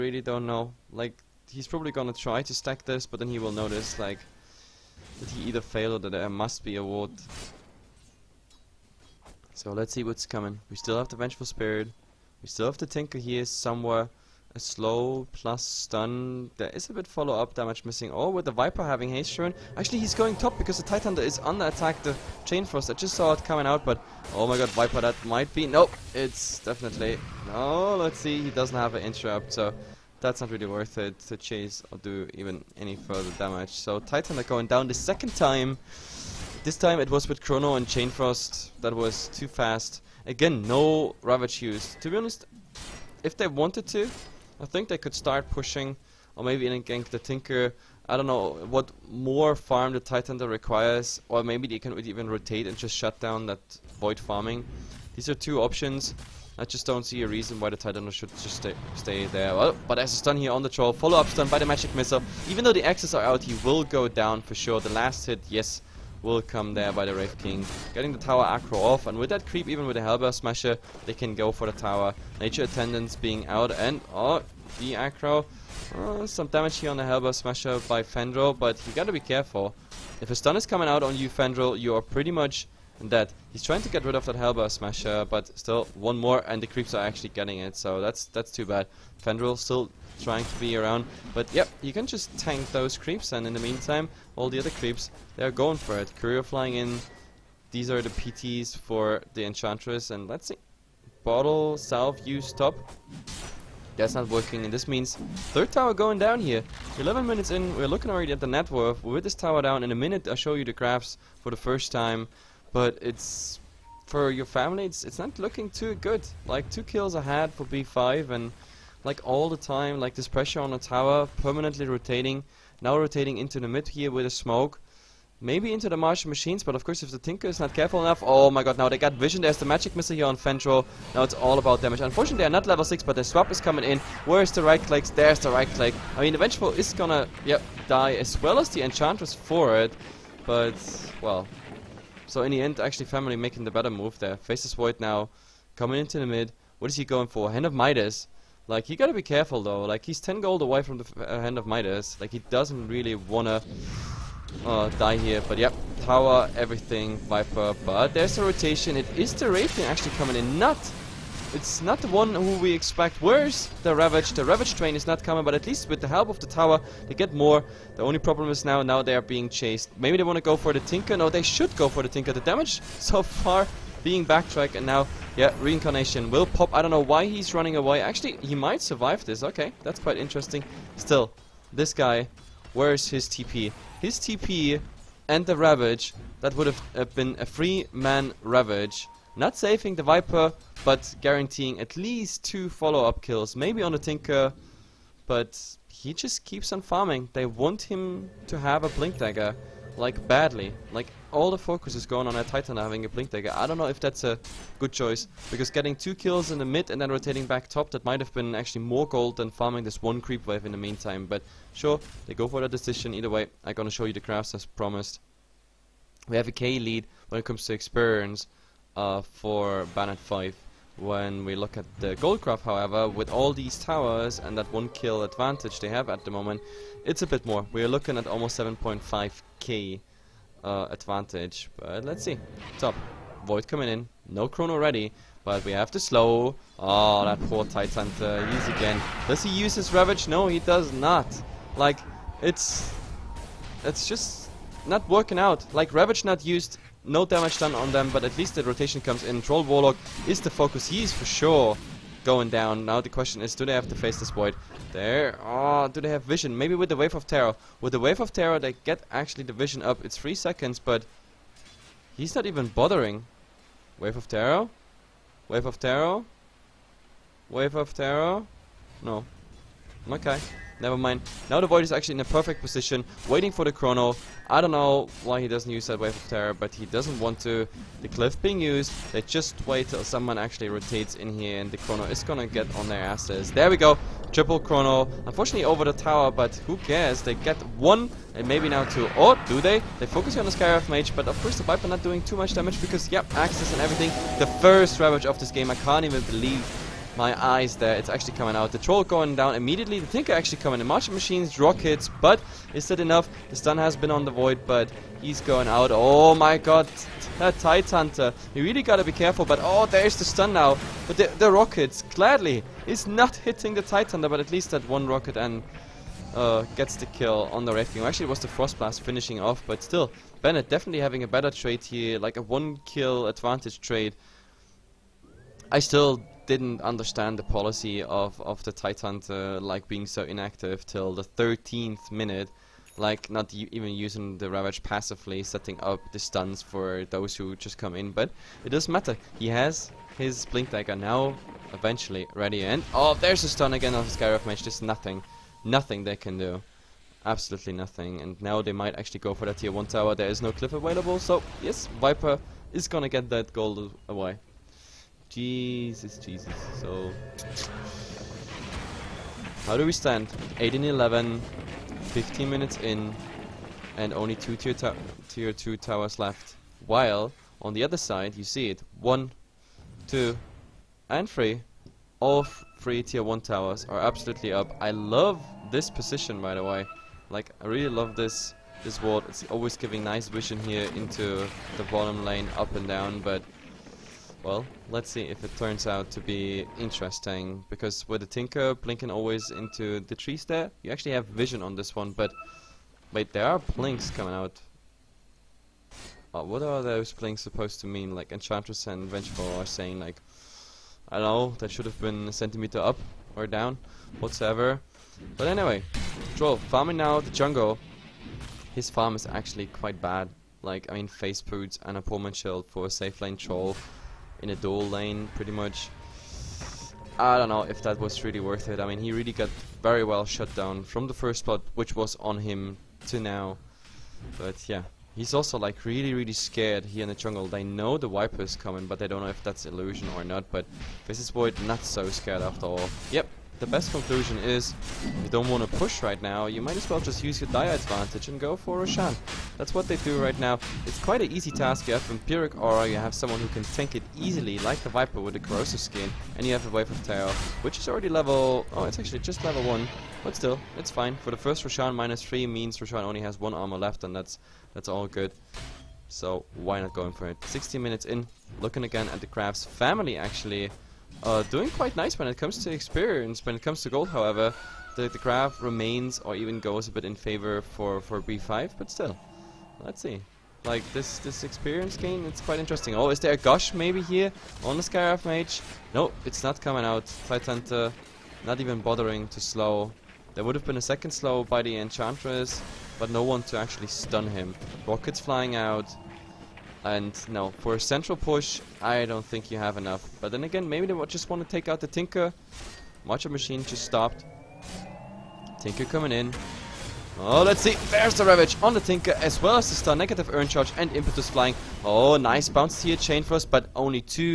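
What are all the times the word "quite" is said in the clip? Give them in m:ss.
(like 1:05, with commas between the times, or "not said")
2:59, 6:49, 7:20, 7:41, 7:52.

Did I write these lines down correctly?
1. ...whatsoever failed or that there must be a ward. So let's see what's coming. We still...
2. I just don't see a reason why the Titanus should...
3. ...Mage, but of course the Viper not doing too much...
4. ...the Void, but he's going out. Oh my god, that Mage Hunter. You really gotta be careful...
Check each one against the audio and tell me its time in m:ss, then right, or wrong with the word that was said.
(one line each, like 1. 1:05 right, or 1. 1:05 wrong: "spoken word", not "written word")
1. 0:05 wrong: "either", not "whatsoever"
2. 0:56 right
3. 4:50 right
4. 5:04 wrong: "Tide", not "Mage".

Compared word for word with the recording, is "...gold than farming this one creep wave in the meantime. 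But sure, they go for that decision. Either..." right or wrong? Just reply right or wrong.
right.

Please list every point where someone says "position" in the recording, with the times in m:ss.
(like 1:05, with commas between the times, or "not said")
4:32, 6:15.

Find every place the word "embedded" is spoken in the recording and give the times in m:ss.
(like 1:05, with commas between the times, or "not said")
not said.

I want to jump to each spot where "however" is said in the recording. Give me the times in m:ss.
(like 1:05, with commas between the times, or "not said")
3:42, 7:44.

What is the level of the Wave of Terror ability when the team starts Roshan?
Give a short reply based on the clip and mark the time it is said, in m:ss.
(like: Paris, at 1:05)
1, at 7:29.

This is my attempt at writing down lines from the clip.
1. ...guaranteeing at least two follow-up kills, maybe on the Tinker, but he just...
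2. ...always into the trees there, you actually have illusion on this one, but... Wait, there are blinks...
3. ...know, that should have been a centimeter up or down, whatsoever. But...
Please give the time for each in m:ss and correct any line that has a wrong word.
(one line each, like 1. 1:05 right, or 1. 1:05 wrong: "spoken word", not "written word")
1. 3:11 right
2. 6:29 wrong: "vision", not "illusion"
3. 6:41 right.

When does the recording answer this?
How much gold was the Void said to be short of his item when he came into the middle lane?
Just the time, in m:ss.
2:30.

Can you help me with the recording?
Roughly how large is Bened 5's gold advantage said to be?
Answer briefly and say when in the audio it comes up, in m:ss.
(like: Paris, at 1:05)
7.5k, at 3:48.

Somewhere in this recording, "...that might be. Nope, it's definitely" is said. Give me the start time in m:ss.
0:25.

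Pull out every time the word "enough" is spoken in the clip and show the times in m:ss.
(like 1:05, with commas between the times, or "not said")
2:07, 5:02, 8:09.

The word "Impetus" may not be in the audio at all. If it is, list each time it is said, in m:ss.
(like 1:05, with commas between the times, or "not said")
8:20.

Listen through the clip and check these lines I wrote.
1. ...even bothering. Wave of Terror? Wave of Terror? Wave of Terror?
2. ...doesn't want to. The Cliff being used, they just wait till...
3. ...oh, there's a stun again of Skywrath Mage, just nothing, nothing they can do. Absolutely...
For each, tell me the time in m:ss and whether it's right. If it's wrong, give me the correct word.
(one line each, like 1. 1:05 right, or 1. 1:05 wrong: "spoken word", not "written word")
1. 4:22 right
2. 4:36 right
3. 5:42 right.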